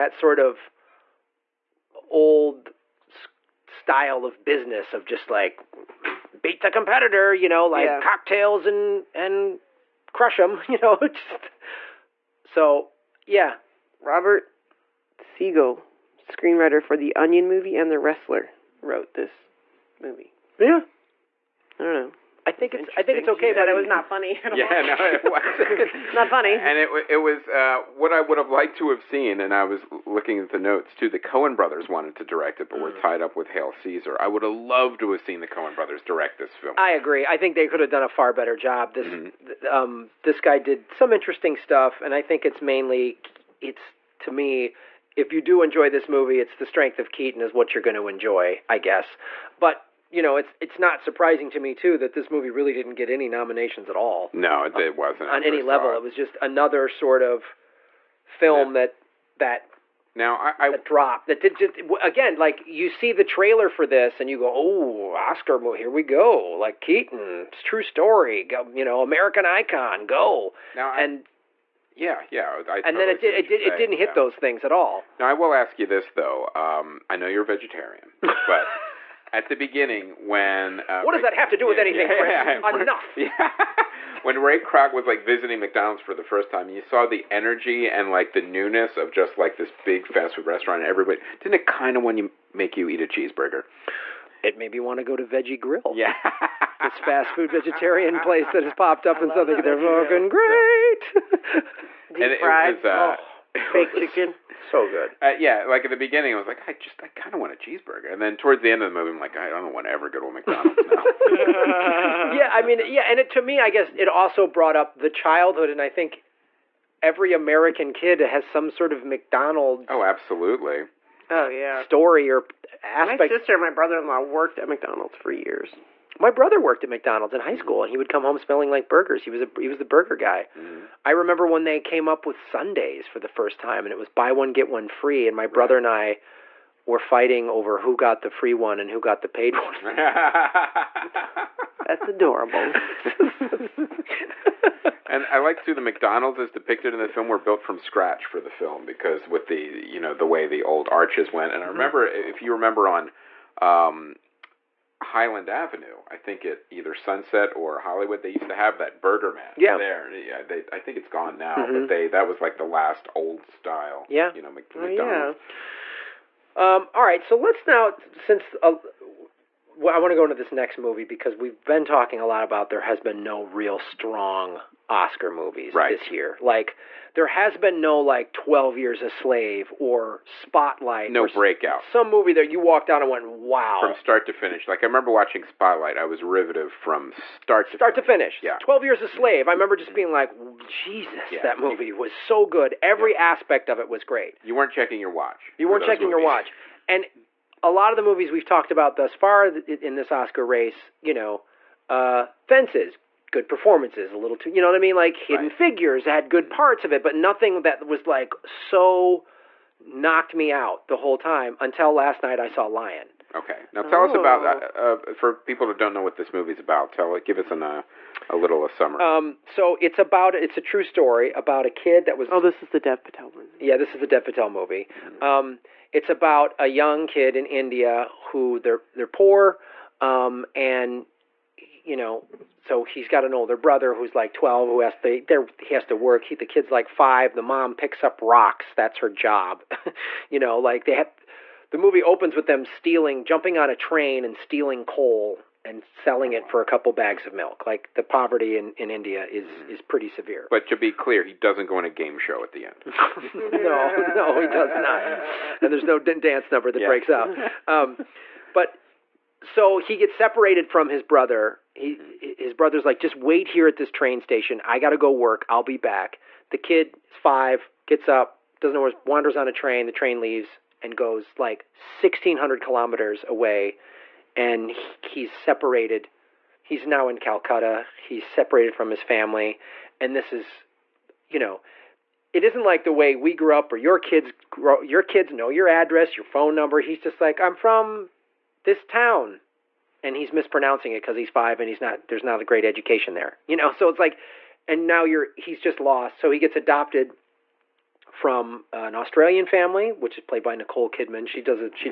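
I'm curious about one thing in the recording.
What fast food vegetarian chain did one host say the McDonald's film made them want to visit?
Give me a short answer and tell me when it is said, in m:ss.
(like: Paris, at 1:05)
Veggie Grill, at 1:35.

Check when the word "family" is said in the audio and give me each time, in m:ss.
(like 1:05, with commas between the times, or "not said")
4:39, 4:59.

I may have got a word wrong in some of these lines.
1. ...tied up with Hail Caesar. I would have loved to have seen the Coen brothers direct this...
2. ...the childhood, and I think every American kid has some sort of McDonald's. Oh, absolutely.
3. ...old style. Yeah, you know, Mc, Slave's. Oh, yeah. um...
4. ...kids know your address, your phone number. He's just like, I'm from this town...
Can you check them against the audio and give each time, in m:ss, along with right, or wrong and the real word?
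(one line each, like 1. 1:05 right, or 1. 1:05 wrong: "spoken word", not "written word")
1. 0:32 right
2. 1:54 right
3. 2:43 wrong: "McDonald", not "Slave"
4. 4:45 right.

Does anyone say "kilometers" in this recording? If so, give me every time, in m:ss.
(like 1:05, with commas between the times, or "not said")
4:32.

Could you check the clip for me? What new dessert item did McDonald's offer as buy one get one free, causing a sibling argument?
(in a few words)
Sundaes.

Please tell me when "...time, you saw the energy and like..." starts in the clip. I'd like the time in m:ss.
1:26.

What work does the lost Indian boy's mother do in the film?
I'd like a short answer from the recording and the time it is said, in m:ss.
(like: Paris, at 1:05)
Picks up rocks, at 3:57.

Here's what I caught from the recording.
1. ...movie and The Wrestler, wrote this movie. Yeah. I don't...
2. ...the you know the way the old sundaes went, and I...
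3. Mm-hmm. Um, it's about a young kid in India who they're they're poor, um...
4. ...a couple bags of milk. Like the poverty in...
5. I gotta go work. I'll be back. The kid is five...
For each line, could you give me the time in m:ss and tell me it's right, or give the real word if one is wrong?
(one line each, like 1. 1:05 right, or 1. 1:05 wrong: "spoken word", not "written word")
1. 0:17 right
2. 2:29 wrong: "arches", not "sundaes"
3. 3:44 right
4. 4:06 right
5. 4:24 right.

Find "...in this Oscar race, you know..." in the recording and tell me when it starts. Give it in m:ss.
3:19.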